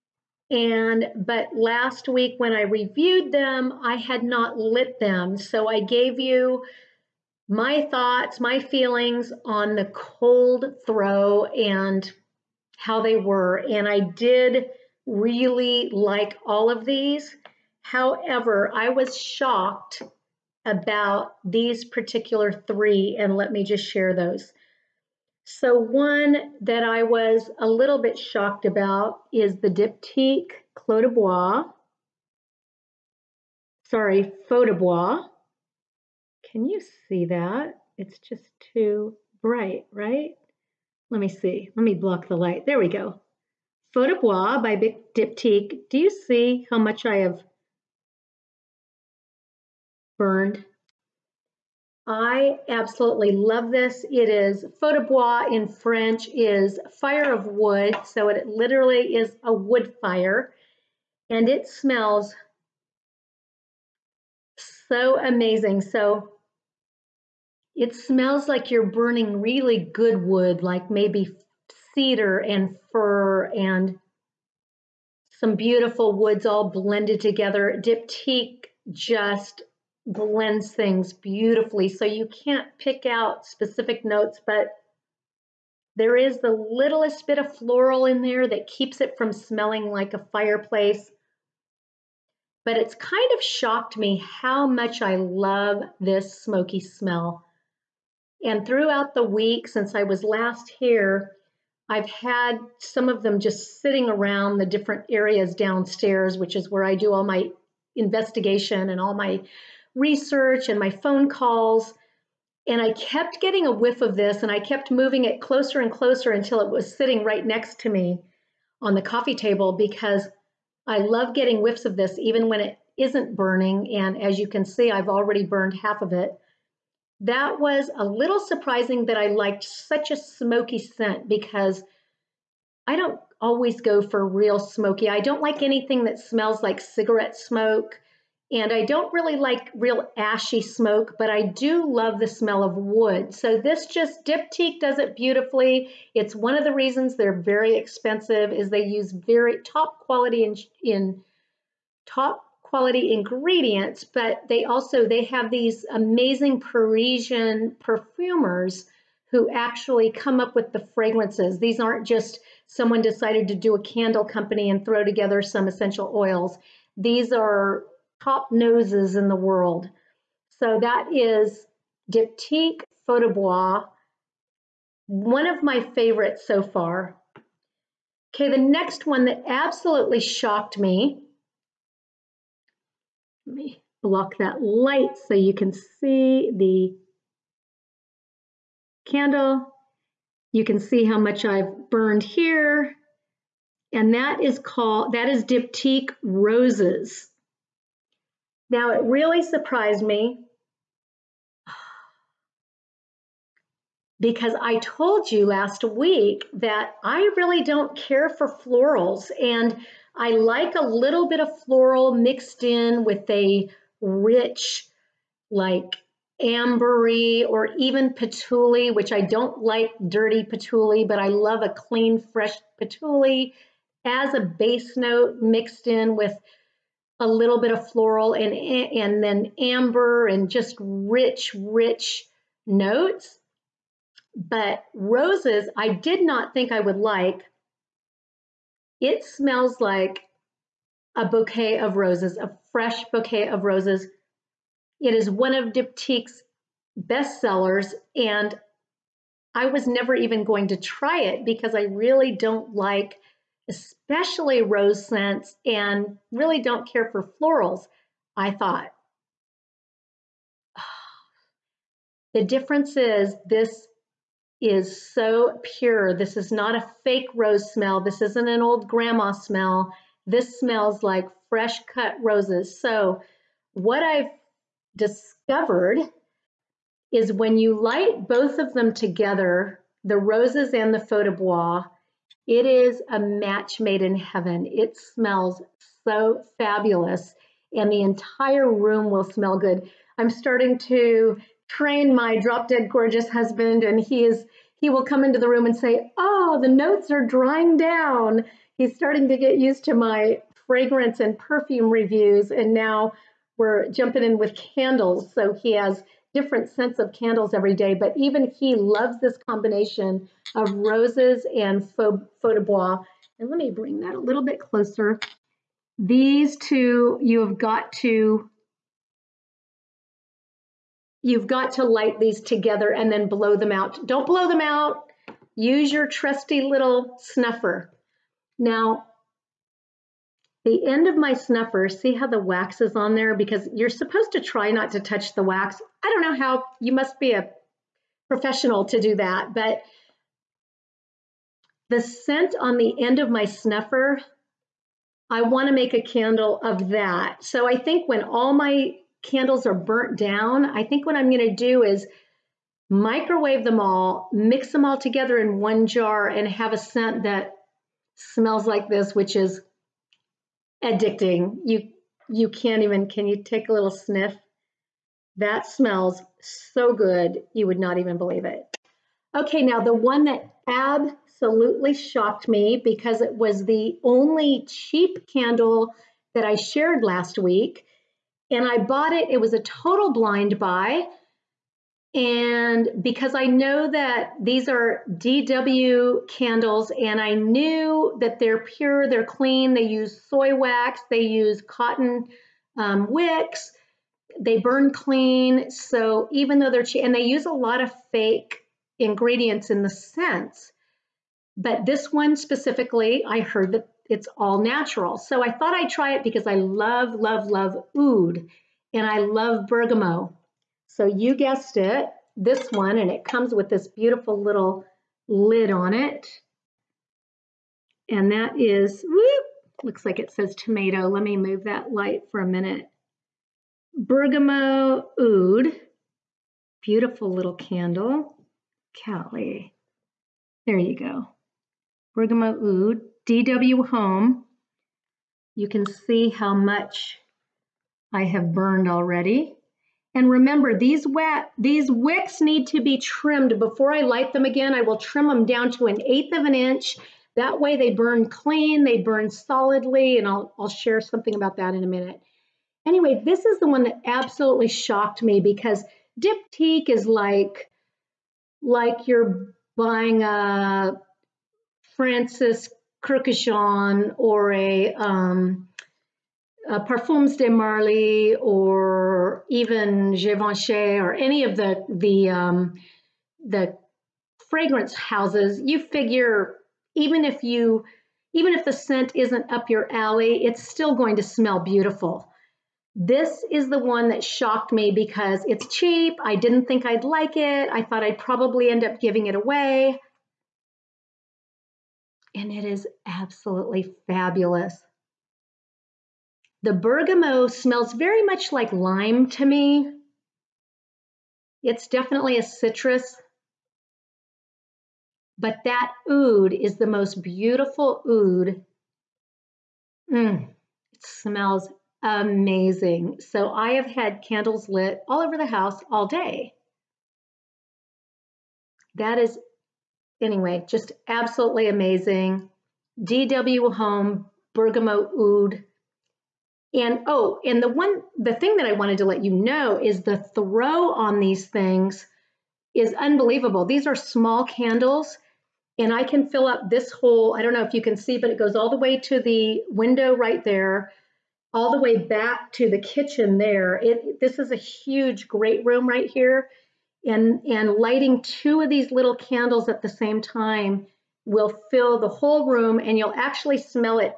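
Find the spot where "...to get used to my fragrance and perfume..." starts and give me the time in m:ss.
4:59.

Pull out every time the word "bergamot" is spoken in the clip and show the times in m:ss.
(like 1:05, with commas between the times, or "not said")
6:49, 7:03, 7:12, 8:16, 8:44.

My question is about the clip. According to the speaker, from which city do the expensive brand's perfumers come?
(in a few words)
Parisian.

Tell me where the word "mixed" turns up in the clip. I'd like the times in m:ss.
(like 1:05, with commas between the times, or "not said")
3:32, 3:45.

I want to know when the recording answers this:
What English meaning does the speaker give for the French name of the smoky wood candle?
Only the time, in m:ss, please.
0:56.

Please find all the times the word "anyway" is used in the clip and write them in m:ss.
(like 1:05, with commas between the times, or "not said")
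7:32, 8:40.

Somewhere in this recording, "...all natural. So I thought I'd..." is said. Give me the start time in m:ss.
6:44.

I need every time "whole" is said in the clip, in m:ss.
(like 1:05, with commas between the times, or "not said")
8:56, 9:12.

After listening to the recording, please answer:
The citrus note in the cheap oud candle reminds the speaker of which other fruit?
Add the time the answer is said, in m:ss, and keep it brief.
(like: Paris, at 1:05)
lime, at 8:18.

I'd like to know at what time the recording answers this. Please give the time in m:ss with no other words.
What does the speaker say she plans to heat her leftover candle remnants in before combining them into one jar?
5:52.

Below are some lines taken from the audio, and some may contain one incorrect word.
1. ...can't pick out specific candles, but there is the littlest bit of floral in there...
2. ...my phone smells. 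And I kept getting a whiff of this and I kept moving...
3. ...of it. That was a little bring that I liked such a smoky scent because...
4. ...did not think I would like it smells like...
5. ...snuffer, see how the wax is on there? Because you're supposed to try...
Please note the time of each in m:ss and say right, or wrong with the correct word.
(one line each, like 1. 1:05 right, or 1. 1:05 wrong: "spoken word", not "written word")
1. 1:22 wrong: "notes", not "candles"
2. 1:50 wrong: "calls", not "smells"
3. 2:06 wrong: "surprising", not "bring"
4. 3:55 right
5. 5:31 right.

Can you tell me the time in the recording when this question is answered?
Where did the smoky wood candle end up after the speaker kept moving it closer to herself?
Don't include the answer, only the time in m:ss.
1:58.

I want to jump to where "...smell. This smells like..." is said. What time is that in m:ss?
4:29.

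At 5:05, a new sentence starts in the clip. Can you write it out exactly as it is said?
So he has different scents of candles every day, but even he loves this combination of roses and feu, feu de bois.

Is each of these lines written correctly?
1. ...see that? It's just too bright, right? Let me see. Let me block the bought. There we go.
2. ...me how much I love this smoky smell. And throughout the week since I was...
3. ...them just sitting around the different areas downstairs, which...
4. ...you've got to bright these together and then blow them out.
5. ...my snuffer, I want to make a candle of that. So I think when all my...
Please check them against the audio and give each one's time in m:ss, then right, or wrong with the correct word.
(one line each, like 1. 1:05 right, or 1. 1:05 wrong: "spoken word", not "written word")
1. 0:37 wrong: "light", not "bought"
2. 1:33 right
3. 1:43 right
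4. 5:21 wrong: "light", not "bright"
5. 5:43 right.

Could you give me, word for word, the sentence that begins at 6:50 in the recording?
So you guessed it, this one, and it comes with this beautiful little lid on it.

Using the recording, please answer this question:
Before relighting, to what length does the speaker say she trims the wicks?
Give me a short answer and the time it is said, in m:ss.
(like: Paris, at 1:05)
1/8 inch, at 7:25.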